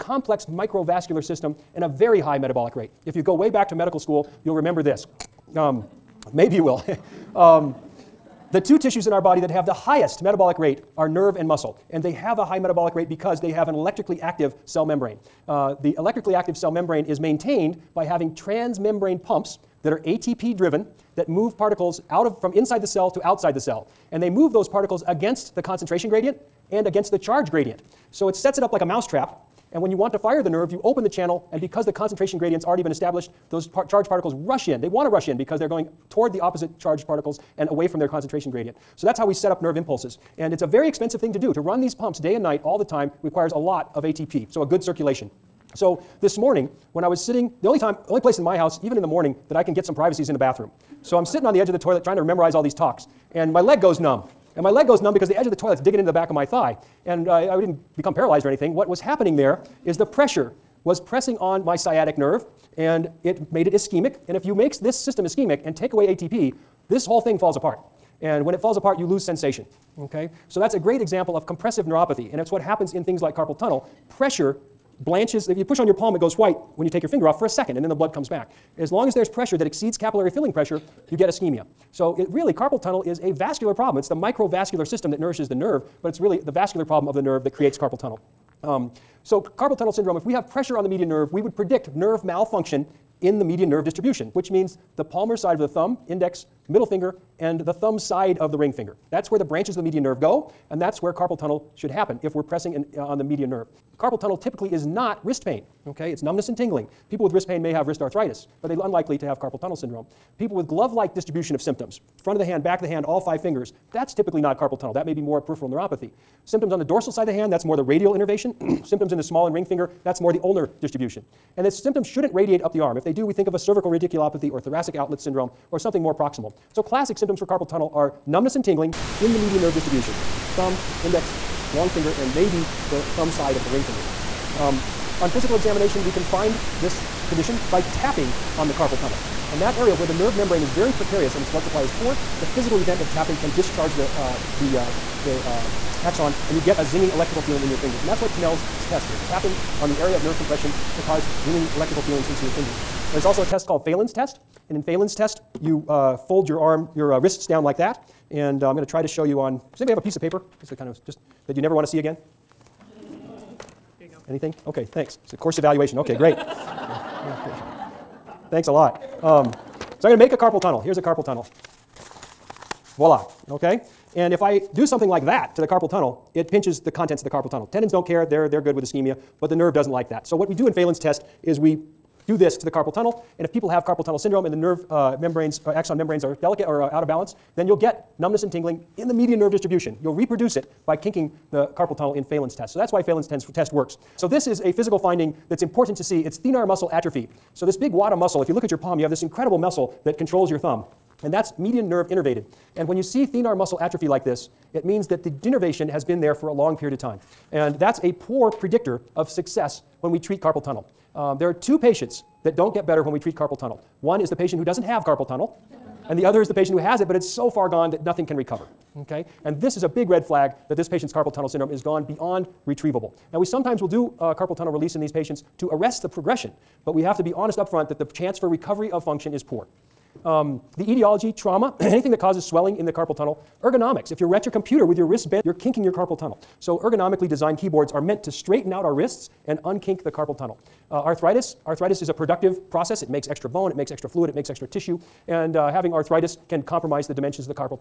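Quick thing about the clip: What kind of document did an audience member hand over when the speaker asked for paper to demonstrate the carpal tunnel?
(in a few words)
A course evaluation.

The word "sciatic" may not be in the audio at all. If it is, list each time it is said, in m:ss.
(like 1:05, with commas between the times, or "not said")
1:01.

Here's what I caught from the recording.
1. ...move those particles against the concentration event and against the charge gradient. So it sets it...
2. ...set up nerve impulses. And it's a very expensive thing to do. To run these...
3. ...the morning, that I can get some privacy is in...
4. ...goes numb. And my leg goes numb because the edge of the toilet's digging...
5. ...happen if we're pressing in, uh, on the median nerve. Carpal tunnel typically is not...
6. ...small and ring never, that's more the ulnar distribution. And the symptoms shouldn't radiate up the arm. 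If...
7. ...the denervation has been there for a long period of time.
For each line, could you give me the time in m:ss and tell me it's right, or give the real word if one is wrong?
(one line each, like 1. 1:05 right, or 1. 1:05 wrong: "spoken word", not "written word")
1. 0:24 wrong: "gradient", not "event"
2. 0:39 right
3. 0:49 right
4. 0:53 right
5. 1:41 right
6. 1:59 wrong: "finger", not "never"
7. 3:25 right.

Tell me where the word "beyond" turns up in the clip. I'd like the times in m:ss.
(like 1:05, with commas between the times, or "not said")
3:42.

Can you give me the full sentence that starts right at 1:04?
And if you make this system ischemic and take away ATP, this whole thing falls apart.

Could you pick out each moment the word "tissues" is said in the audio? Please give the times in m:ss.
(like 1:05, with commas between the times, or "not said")
0:08, 4:04.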